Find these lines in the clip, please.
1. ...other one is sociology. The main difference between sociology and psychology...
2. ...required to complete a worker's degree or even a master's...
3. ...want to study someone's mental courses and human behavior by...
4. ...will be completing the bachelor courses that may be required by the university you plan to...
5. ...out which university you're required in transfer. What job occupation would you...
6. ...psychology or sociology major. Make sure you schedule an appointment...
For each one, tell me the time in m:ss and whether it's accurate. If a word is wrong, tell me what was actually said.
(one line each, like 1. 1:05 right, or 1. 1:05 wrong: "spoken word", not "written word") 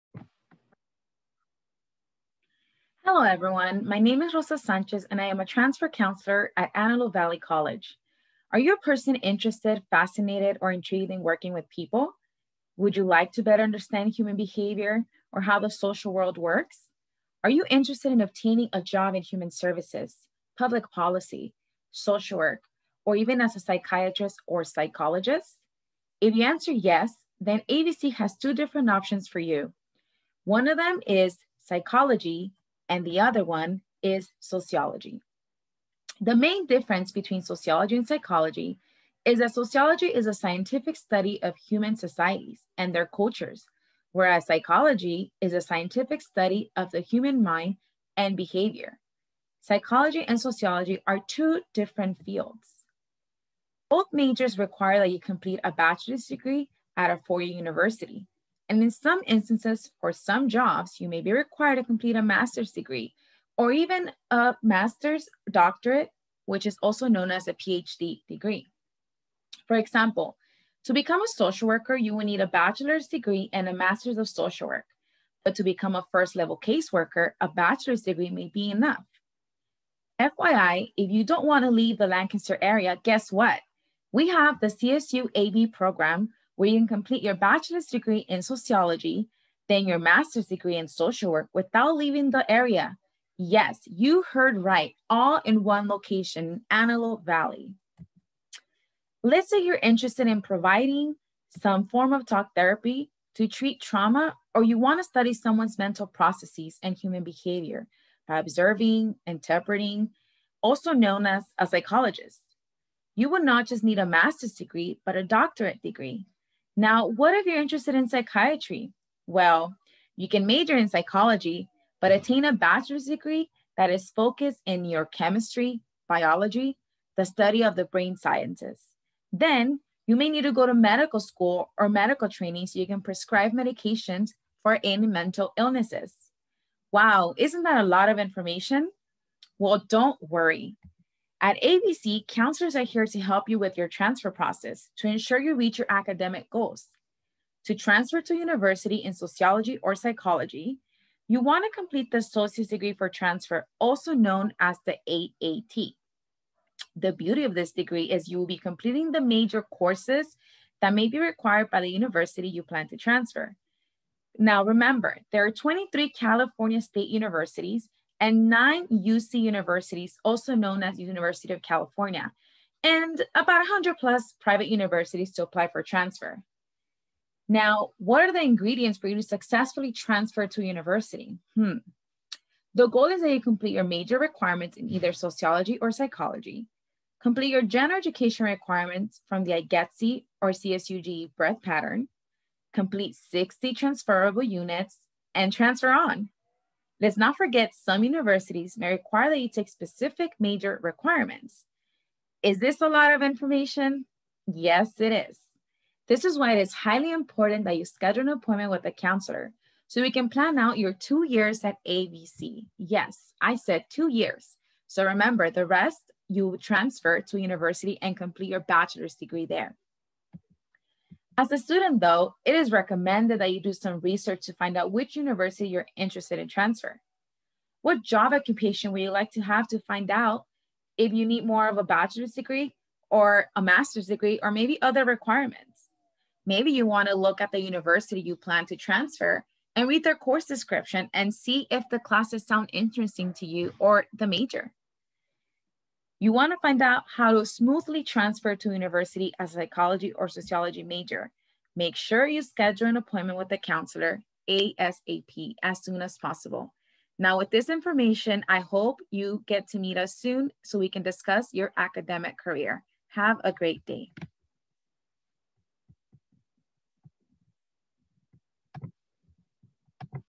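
1. 0:33 right
2. 1:01 wrong: "master", not "worker"
3. 1:44 wrong: "processes", not "courses"
4. 2:38 wrong: "major", not "bachelor"
5. 3:44 wrong: "interested", not "required"
6. 4:09 right.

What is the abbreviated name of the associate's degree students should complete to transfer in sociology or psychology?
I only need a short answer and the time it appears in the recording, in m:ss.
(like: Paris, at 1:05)
AAT, at 2:35.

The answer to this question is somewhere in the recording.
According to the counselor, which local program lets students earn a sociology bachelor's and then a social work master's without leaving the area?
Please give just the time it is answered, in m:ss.
1:24.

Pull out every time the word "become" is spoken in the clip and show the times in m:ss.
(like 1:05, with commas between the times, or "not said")
1:10, 1:15.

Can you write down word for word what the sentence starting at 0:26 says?
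If you answer yes, then AVC has two different options for you.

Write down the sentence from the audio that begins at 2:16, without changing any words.
Wow, isn't that a lot of information?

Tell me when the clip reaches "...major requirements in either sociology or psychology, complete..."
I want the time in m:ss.
3:03.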